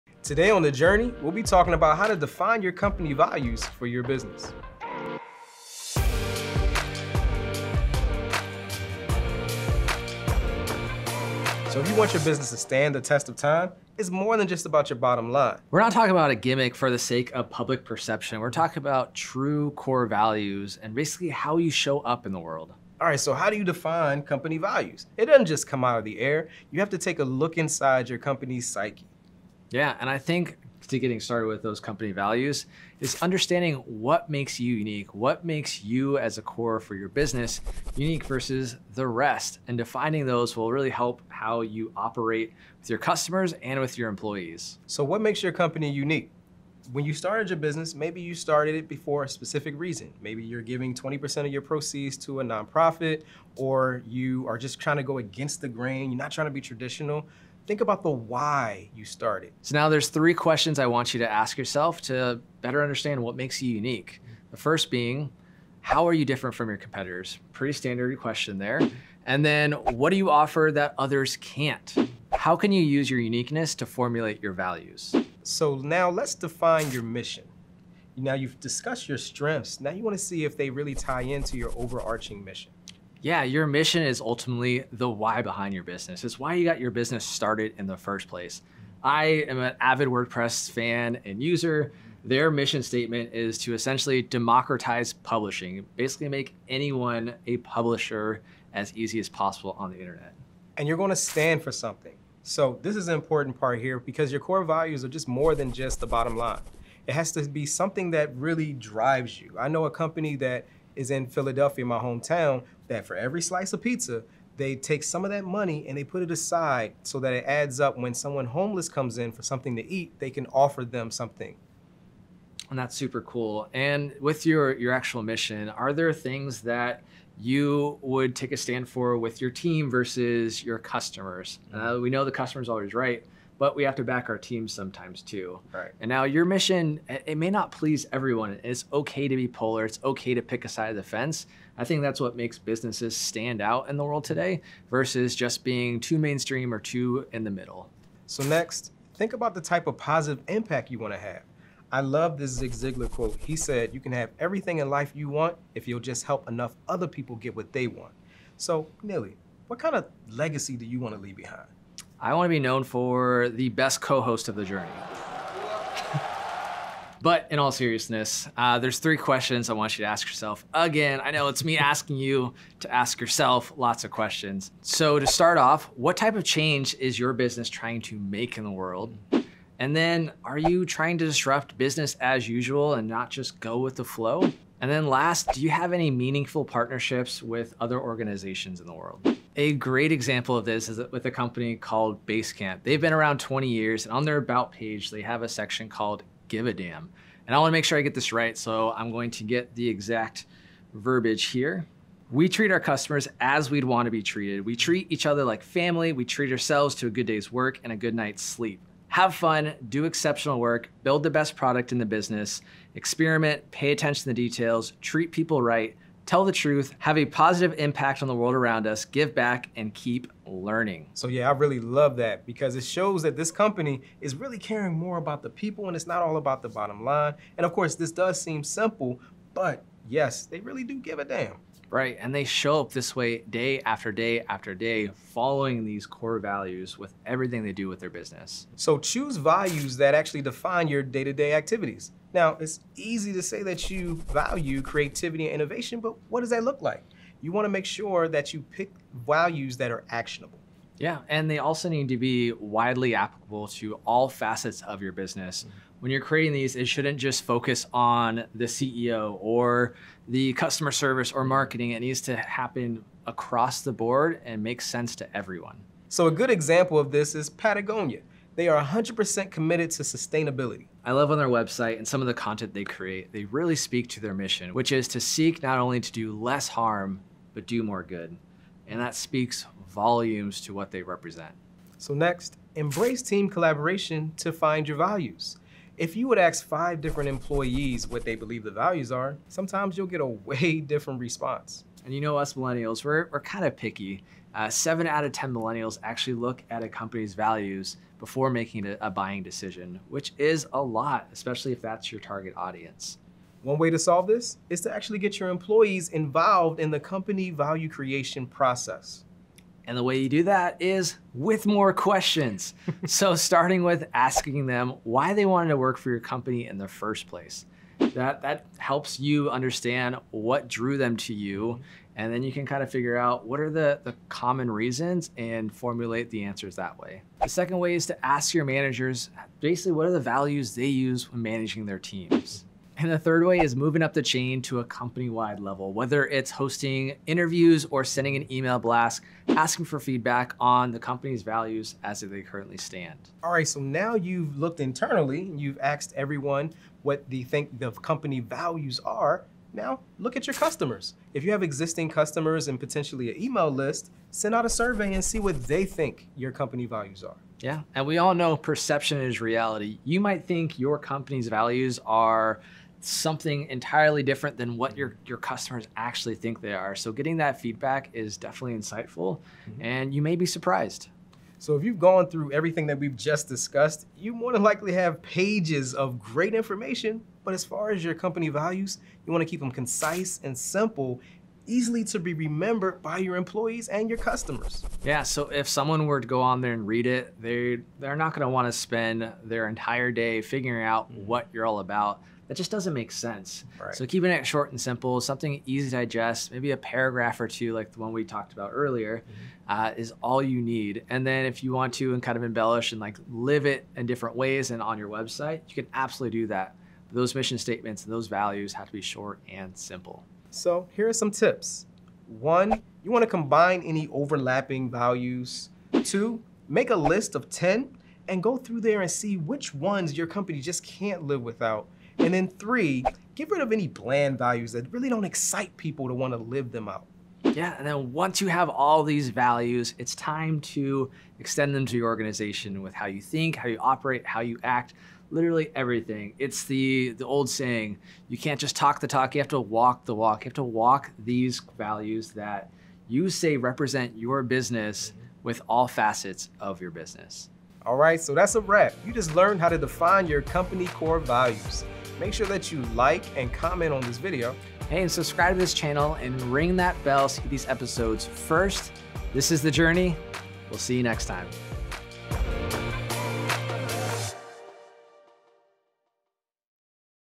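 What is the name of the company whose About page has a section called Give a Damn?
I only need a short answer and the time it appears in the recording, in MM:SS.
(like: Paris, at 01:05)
Basecamp, at 03:12.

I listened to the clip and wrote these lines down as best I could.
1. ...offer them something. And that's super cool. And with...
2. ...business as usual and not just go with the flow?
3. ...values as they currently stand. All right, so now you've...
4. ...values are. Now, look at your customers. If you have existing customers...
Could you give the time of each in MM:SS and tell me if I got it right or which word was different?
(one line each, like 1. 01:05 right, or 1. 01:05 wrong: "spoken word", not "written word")
1. 02:00 right
2. 03:01 right
3. 05:41 right
4. 05:48 right.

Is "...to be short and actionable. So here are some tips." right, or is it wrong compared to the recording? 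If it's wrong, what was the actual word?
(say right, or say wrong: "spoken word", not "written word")
wrong: "simple", not "actionable".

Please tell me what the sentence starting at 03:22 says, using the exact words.
We treat our customers as we'd want to be treated.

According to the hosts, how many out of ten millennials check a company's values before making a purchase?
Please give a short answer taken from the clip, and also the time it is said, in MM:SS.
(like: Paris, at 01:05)
7, at 04:54.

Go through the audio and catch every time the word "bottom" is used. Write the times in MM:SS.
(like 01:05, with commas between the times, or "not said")
00:14, 01:46, 03:46.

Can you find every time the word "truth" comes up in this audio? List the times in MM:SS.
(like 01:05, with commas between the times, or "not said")
03:36.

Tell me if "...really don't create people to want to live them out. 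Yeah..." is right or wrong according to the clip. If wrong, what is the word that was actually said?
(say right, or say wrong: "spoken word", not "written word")
wrong: "excite", not "create".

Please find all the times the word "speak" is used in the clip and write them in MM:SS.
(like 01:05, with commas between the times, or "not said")
04:33, 04:39.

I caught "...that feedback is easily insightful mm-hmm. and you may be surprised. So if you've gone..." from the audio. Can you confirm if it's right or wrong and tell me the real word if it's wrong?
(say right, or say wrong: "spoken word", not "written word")
wrong: "definitely", not "easily".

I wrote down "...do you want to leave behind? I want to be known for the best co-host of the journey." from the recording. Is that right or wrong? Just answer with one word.
right.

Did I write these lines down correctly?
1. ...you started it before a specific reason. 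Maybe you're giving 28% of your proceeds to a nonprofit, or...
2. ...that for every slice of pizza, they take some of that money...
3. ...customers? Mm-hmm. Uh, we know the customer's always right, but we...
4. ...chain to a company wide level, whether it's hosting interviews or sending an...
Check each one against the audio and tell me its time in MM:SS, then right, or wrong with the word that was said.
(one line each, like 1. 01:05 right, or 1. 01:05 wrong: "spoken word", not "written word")
1. 00:48 wrong: "20", not "28"
2. 01:52 right
3. 02:10 right
4. 05:34 right.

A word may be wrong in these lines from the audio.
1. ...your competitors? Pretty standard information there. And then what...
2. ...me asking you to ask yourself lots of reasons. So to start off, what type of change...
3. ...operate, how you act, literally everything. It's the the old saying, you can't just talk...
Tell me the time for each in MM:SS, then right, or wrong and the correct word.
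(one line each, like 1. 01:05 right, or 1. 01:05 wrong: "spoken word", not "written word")
1. 01:06 wrong: "question", not "information"
2. 02:51 wrong: "questions", not "reasons"
3. 07:13 right.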